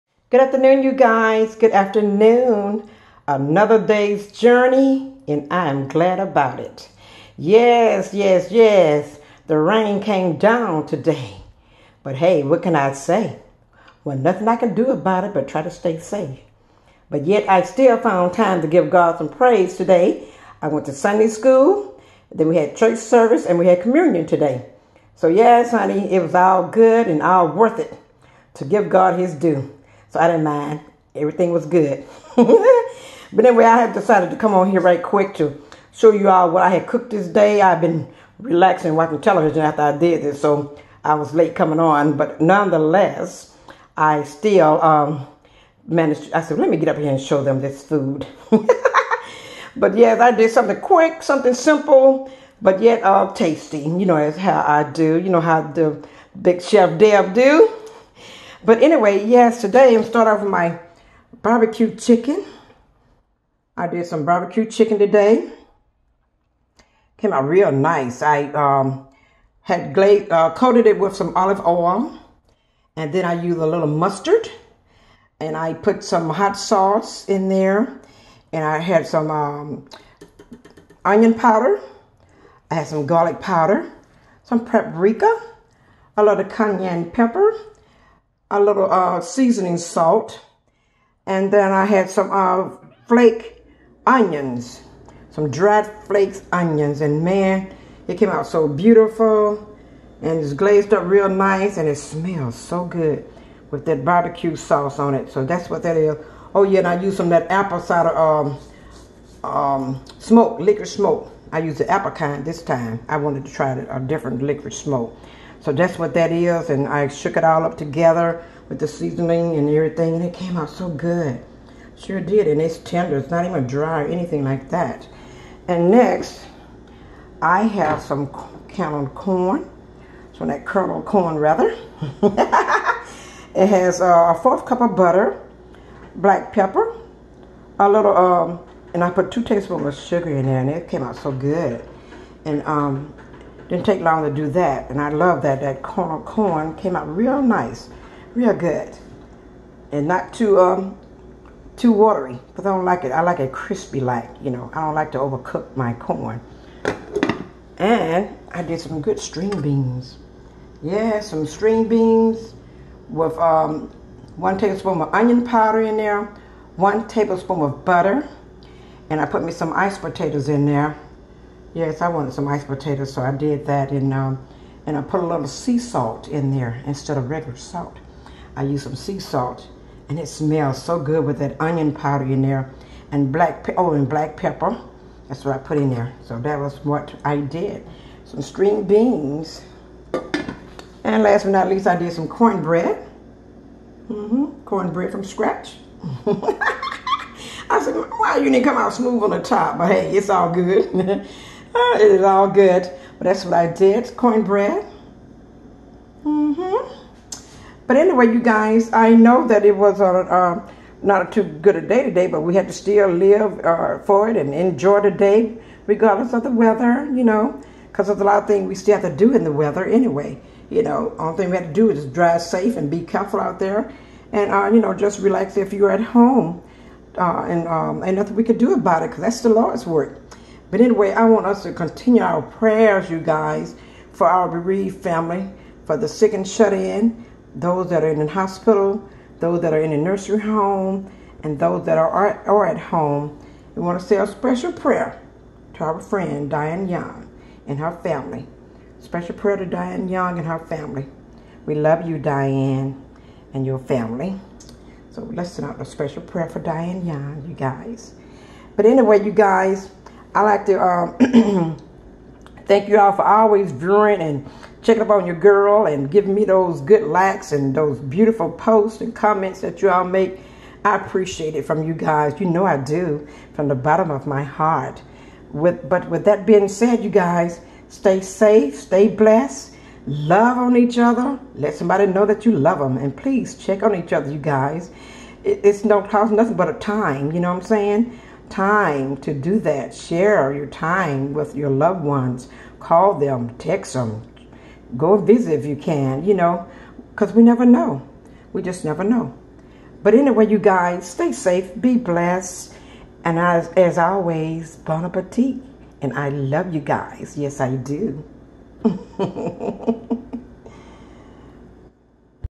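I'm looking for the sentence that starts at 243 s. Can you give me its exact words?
We want to say a special prayer to our friend Diane Young and her family.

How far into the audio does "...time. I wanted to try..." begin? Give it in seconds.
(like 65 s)
112 s.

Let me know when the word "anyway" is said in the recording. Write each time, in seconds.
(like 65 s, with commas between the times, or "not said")
33 s, 58 s, 207 s, 219 s, 230 s, 258 s, 300 s.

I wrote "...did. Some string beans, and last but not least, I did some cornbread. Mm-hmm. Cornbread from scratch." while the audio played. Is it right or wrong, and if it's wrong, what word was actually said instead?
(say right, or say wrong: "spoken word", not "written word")
right.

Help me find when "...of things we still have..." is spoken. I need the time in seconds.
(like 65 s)
218 s.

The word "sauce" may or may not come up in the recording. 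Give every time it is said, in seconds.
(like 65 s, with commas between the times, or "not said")
76 s, 104 s.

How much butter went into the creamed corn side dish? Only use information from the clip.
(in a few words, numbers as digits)
A fourth cup.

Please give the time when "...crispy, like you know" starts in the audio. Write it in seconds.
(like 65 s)
153 s.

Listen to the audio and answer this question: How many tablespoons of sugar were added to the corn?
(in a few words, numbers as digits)
2.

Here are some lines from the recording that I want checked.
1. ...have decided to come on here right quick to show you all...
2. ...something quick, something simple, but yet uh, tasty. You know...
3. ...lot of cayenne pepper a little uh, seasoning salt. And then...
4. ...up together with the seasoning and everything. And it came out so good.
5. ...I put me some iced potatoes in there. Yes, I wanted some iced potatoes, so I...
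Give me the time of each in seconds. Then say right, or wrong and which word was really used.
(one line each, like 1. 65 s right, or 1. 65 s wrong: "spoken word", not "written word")
1. 33 s right
2. 50 s right
3. 86 s right
4. 117 s right
5. 169 s right.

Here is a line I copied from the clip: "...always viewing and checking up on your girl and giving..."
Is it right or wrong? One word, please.
right.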